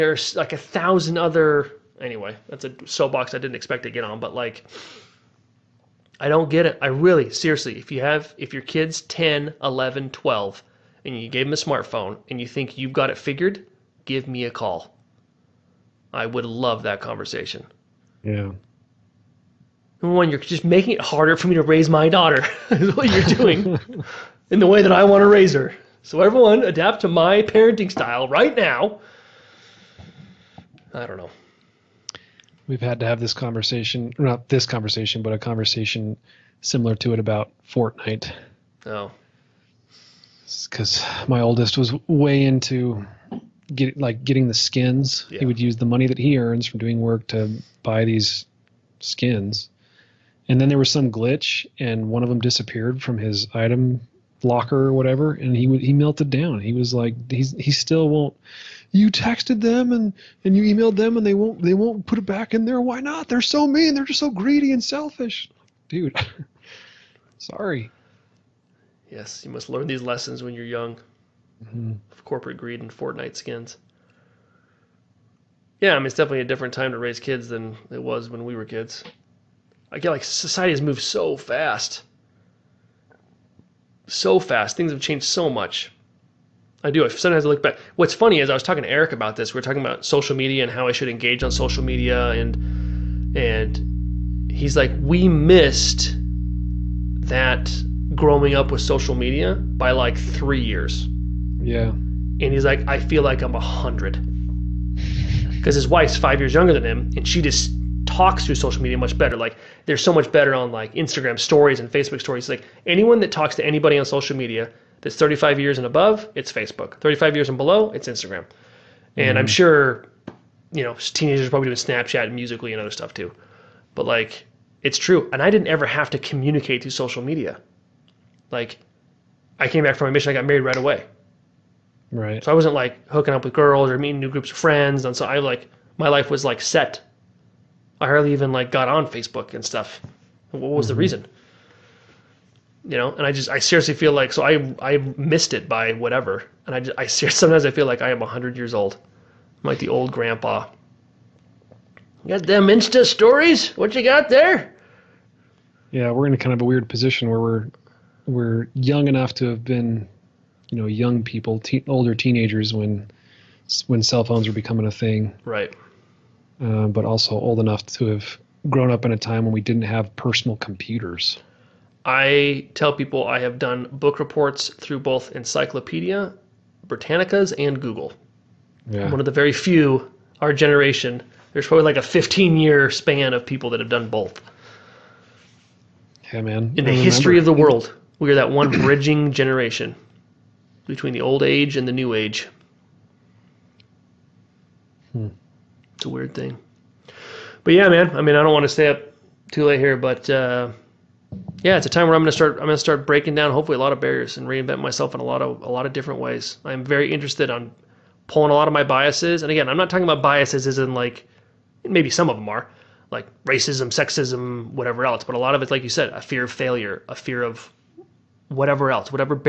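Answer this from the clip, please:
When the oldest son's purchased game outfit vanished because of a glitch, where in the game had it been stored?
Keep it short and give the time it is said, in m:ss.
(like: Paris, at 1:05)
item locker, at 0:53.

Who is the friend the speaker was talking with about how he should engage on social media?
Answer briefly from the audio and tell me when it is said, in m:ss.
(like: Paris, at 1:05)
Eric, at 1:28.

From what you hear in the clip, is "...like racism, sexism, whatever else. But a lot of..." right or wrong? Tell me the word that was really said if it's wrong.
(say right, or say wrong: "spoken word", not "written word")
right.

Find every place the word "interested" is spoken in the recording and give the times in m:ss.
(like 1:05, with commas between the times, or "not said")
3:27.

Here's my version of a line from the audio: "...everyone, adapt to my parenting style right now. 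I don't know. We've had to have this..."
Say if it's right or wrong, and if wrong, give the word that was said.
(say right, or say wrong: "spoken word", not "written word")
right.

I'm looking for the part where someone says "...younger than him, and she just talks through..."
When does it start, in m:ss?
1:46.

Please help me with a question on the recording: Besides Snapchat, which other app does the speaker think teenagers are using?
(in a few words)
Musically.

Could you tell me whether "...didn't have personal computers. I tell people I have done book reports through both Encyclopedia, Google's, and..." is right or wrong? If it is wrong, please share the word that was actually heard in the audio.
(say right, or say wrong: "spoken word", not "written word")
wrong: "Britannica", not "Google".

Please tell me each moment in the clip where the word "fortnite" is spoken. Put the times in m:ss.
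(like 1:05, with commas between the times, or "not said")
0:37, 1:12.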